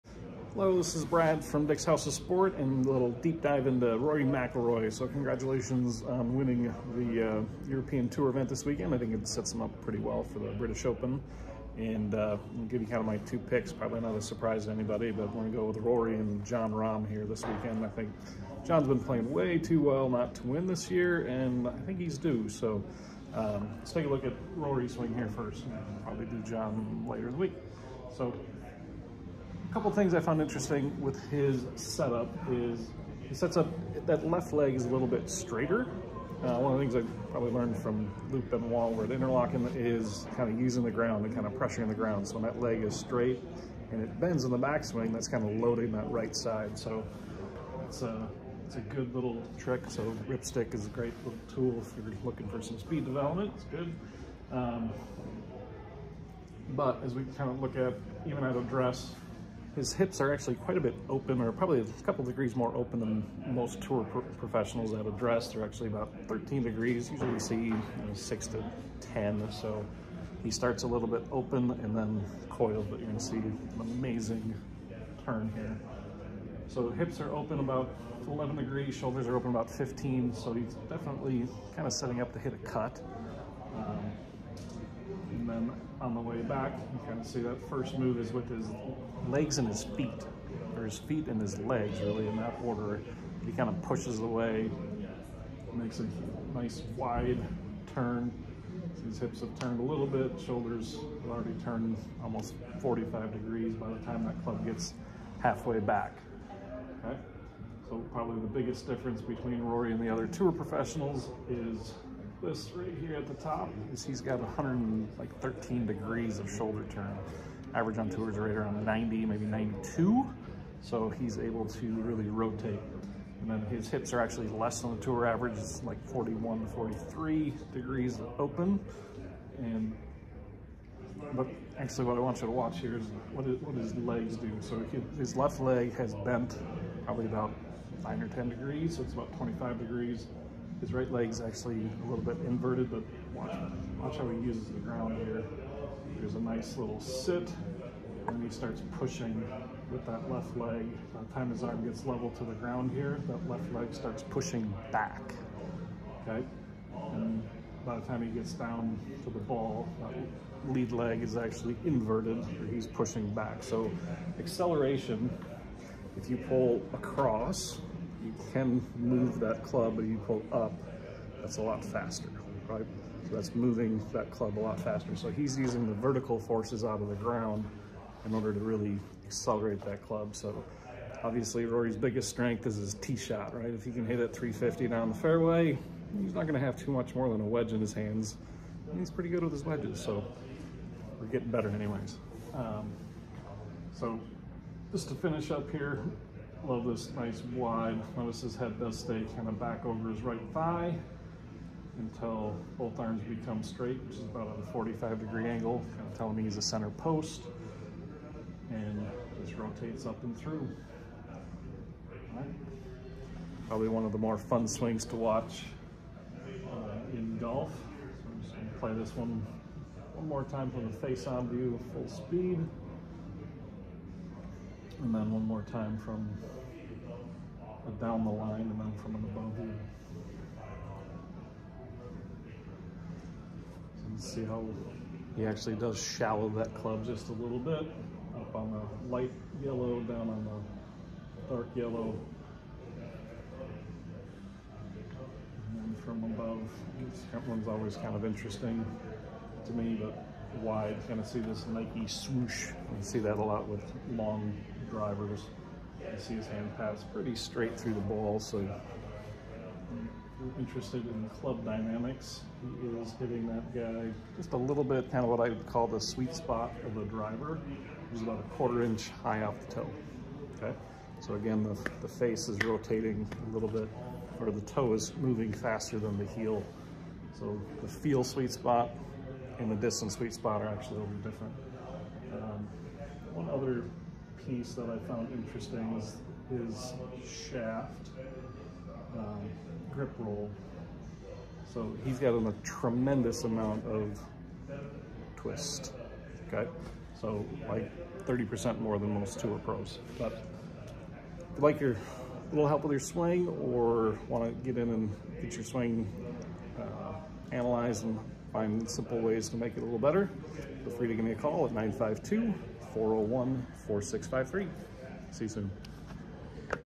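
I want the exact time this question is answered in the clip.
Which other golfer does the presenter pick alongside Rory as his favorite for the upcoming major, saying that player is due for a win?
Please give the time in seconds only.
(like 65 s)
16 s.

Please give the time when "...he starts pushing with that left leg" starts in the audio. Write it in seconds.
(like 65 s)
148 s.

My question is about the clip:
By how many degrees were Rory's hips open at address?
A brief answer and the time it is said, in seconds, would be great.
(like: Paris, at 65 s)
13, at 66 s.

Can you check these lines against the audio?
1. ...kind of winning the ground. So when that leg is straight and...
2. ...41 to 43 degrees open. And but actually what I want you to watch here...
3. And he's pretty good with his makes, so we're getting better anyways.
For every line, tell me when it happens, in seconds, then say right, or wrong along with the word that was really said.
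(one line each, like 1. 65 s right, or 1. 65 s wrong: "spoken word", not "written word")
1. 41 s wrong: "pressuring", not "winning"
2. 126 s right
3. 188 s wrong: "wedges", not "makes".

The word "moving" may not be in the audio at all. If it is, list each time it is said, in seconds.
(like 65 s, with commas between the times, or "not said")
173 s, 275 s.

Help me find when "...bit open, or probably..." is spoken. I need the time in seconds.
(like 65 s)
60 s.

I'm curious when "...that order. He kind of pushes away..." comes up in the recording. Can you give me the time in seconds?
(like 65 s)
92 s.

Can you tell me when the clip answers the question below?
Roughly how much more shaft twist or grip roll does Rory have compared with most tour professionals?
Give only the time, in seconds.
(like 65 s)
298 s.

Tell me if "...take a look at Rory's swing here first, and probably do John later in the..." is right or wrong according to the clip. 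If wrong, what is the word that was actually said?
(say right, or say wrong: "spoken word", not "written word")
right.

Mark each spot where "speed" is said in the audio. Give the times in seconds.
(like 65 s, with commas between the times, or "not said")
52 s, 222 s.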